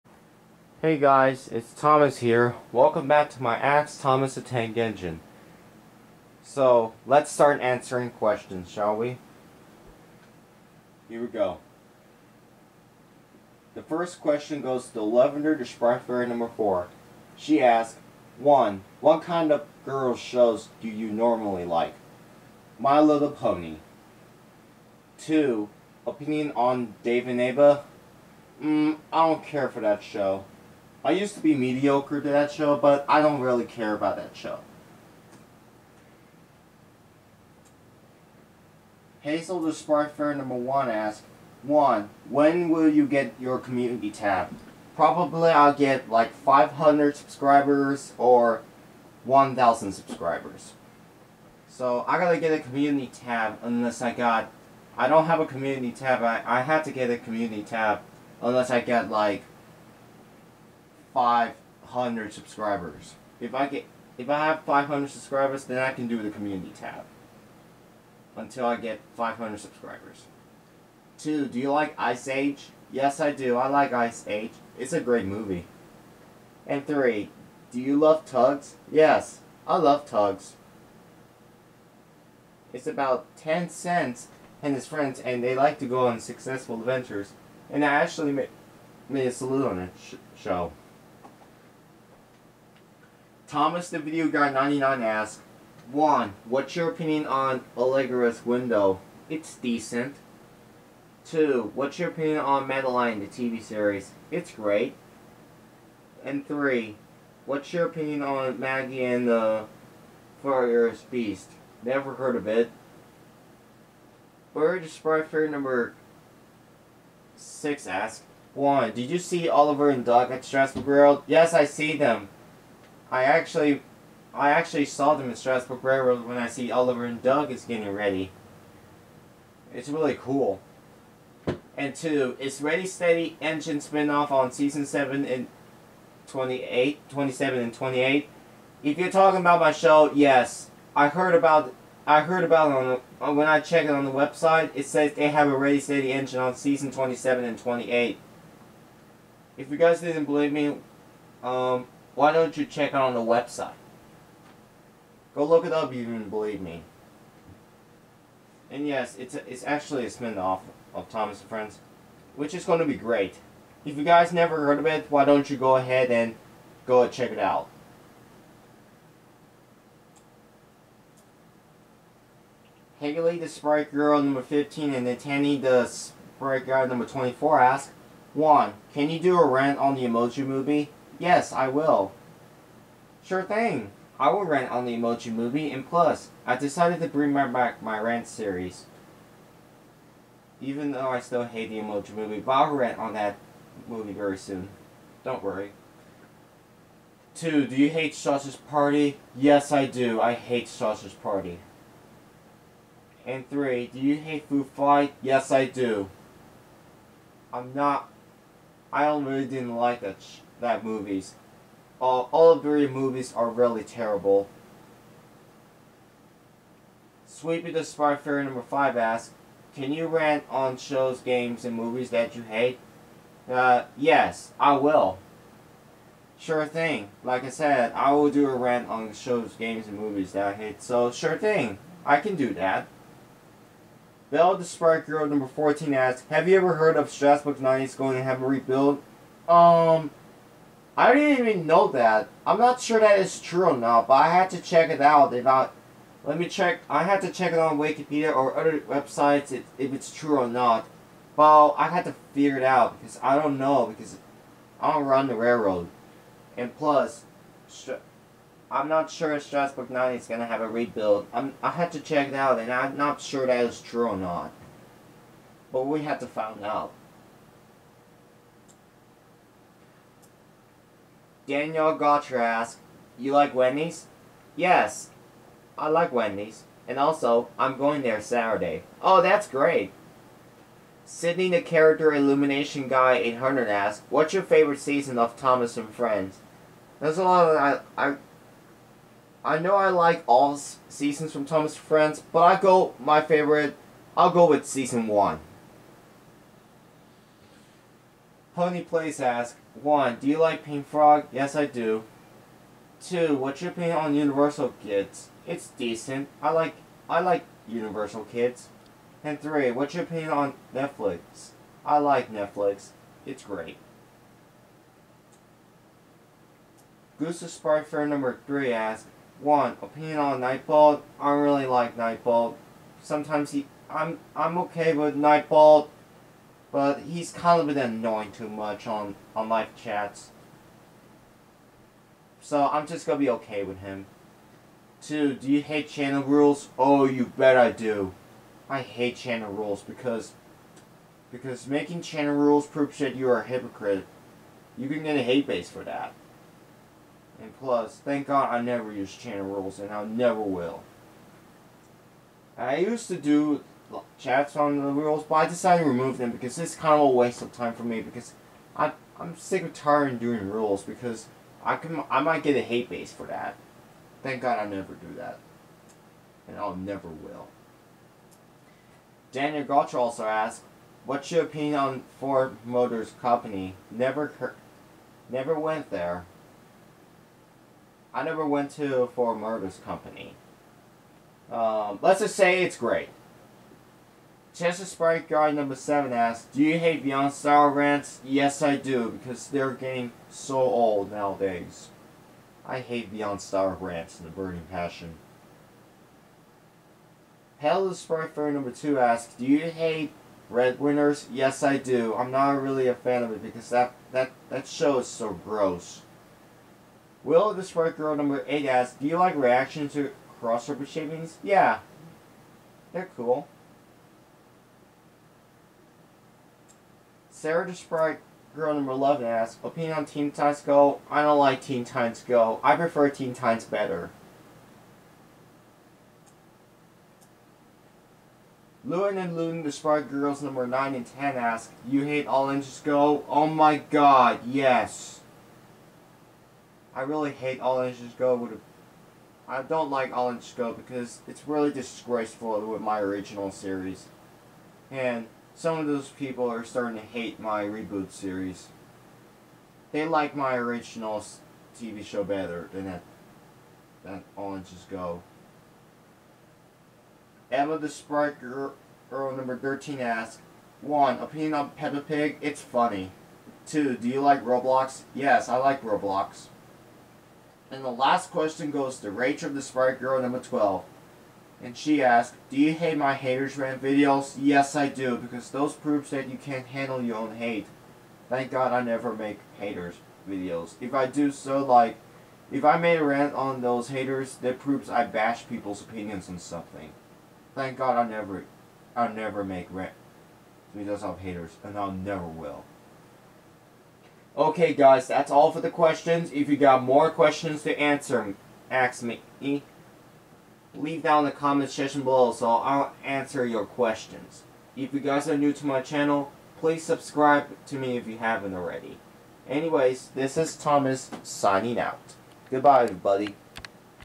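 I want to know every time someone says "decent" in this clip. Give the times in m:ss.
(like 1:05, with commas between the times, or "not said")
1:39, 5:05.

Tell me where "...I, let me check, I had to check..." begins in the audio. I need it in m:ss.
4:05.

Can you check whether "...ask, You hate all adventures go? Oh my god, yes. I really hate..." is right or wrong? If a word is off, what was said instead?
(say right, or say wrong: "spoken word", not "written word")
wrong: "engines", not "adventures".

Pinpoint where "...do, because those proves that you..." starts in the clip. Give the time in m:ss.
7:54.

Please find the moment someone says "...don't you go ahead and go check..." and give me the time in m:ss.
2:45.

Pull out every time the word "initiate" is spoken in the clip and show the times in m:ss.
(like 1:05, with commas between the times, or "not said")
not said.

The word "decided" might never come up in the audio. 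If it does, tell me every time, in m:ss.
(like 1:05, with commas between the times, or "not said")
3:06, 5:55.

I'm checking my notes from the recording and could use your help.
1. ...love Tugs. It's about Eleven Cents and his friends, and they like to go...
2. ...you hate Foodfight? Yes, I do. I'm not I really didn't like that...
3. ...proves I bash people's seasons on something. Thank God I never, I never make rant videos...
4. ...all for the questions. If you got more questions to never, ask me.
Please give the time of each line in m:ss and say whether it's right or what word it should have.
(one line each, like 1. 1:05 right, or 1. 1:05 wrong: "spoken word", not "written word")
1. 1:19 wrong: "Ten", not "Eleven"
2. 3:23 right
3. 8:04 wrong: "opinions", not "seasons"
4. 8:15 wrong: "answer", not "never".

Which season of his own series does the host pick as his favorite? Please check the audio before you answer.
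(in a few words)
Season one.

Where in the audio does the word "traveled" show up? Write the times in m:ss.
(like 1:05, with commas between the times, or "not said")
not said.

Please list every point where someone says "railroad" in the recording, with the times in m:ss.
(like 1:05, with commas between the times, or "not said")
2:05, 4:15.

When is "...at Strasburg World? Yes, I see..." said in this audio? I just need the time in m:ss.
2:00.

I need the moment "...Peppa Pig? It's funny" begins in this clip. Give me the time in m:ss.
7:41.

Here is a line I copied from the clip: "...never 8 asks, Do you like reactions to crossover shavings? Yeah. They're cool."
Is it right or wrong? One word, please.
wrong.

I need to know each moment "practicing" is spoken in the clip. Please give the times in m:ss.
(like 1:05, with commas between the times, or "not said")
not said.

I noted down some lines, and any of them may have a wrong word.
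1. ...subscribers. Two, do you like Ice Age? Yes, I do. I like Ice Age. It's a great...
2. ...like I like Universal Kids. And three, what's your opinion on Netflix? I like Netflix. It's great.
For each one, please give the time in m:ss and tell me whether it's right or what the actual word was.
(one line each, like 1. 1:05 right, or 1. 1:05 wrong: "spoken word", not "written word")
1. 1:09 right
2. 5:06 right.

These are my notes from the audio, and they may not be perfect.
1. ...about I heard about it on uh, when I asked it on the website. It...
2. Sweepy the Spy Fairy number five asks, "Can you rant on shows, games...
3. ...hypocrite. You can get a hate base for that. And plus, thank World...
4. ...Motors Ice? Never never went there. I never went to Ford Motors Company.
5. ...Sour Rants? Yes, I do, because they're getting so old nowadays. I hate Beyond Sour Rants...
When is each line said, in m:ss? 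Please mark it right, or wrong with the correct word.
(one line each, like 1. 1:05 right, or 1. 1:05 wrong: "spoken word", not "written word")
1. 2:21 wrong: "checked", not "asked"
2. 3:37 right
3. 5:43 wrong: "God", not "World"
4. 6:12 wrong: "Company", not "Ice"
5. 6:27 right.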